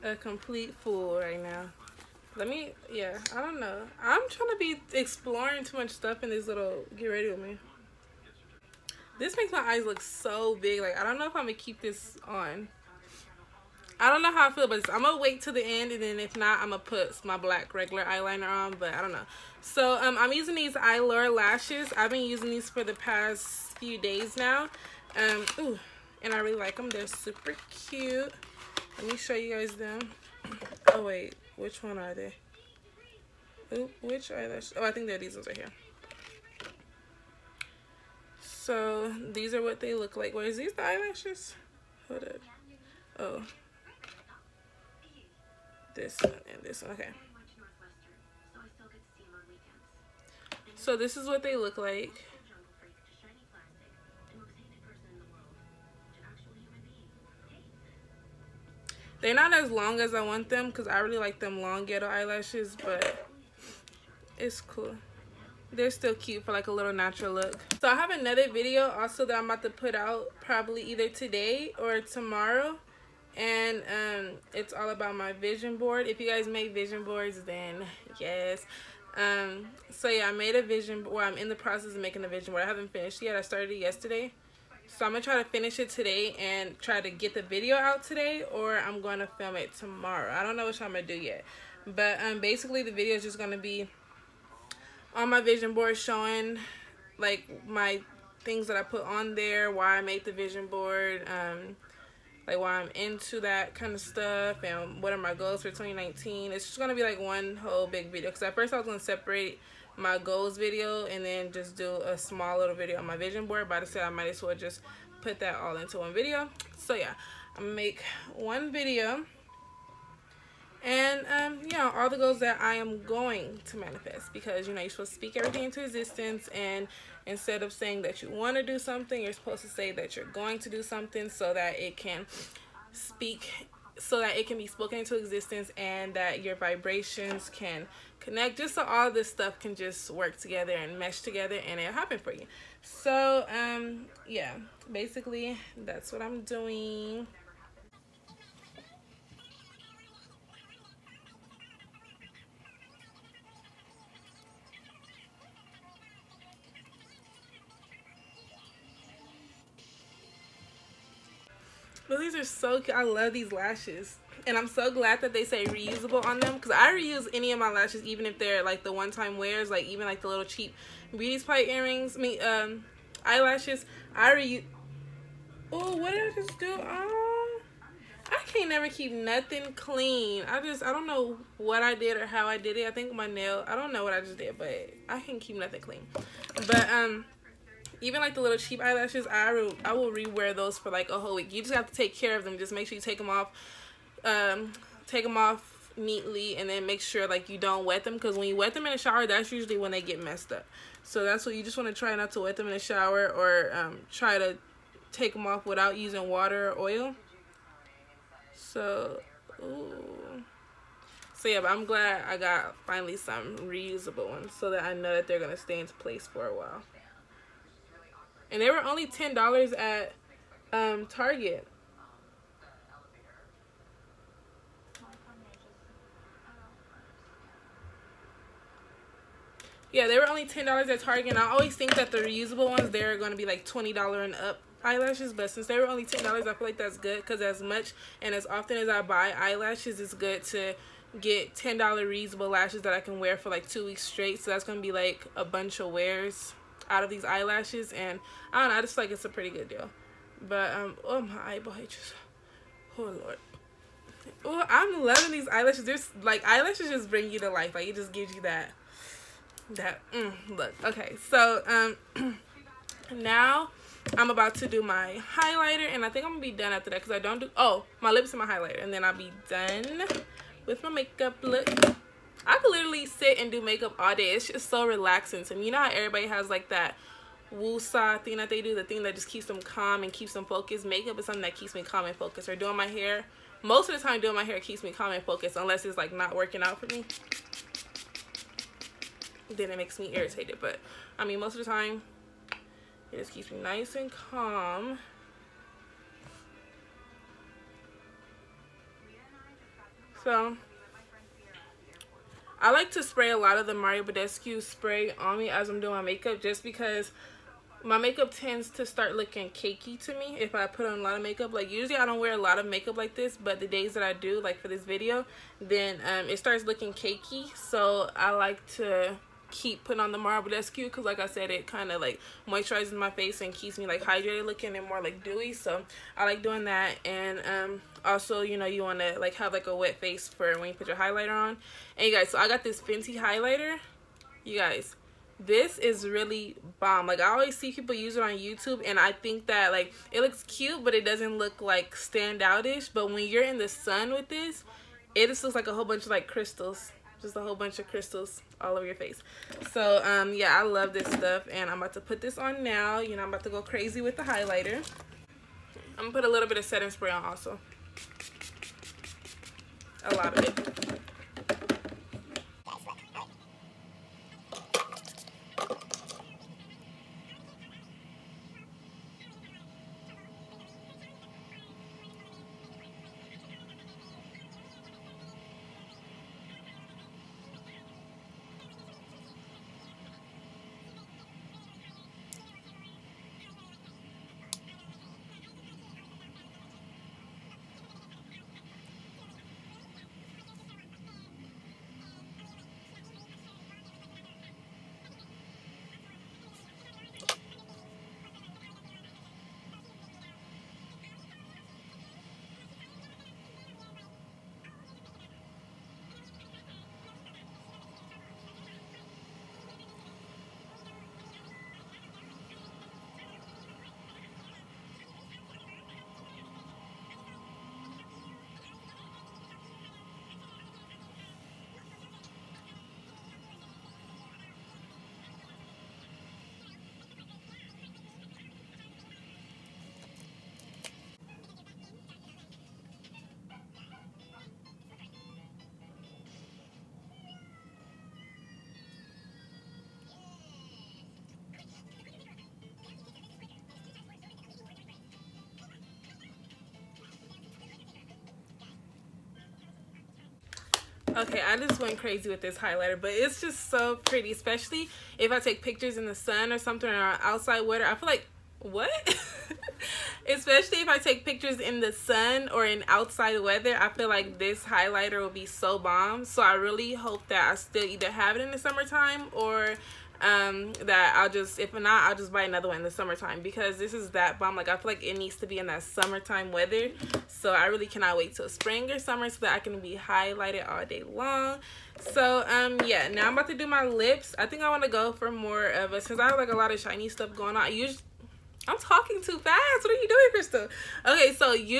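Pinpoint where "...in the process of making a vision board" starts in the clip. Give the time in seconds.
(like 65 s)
81 s.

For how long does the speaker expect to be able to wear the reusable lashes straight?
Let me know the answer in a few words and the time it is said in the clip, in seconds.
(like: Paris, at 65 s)
2 weeks, at 243 s.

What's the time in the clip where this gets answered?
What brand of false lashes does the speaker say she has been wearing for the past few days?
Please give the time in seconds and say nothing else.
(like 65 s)
20 s.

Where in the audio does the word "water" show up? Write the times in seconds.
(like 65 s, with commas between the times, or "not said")
206 s.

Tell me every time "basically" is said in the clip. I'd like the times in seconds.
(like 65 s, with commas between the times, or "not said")
92 s, 144 s.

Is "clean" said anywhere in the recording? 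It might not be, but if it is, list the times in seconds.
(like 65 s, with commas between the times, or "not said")
179 s, 185 s.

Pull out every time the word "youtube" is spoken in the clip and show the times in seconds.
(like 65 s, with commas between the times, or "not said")
338 s.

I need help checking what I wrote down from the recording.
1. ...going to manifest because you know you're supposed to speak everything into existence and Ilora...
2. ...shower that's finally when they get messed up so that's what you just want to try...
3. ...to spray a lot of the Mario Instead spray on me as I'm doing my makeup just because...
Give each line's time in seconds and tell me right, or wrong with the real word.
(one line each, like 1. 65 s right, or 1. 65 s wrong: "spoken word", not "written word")
1. 123 s wrong: "Instead", not "Ilora"
2. 198 s wrong: "usually", not "finally"
3. 302 s wrong: "Badescu", not "Instead".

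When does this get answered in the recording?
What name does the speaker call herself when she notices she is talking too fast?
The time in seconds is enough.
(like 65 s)
490 s.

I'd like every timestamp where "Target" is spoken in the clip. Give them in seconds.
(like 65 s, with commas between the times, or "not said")
221 s, 231 s.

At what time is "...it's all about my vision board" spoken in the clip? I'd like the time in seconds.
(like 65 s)
74 s.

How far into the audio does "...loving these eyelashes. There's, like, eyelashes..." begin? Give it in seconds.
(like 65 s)
255 s.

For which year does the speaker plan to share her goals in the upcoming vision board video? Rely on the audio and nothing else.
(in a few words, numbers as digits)
2019.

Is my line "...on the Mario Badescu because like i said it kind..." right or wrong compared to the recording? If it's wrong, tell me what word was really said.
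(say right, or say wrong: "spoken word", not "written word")
right.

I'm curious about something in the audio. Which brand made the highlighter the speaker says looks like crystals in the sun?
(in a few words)
Fenty.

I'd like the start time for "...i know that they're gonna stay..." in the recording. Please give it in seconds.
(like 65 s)
214 s.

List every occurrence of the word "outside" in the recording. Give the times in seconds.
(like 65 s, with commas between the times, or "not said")
457 s, 462 s.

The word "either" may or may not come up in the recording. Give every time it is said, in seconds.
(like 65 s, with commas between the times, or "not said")
70 s, 467 s.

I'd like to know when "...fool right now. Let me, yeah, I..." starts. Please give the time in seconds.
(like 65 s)
0 s.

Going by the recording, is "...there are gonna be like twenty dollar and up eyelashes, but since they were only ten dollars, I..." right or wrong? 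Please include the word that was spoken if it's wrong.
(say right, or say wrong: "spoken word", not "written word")
right.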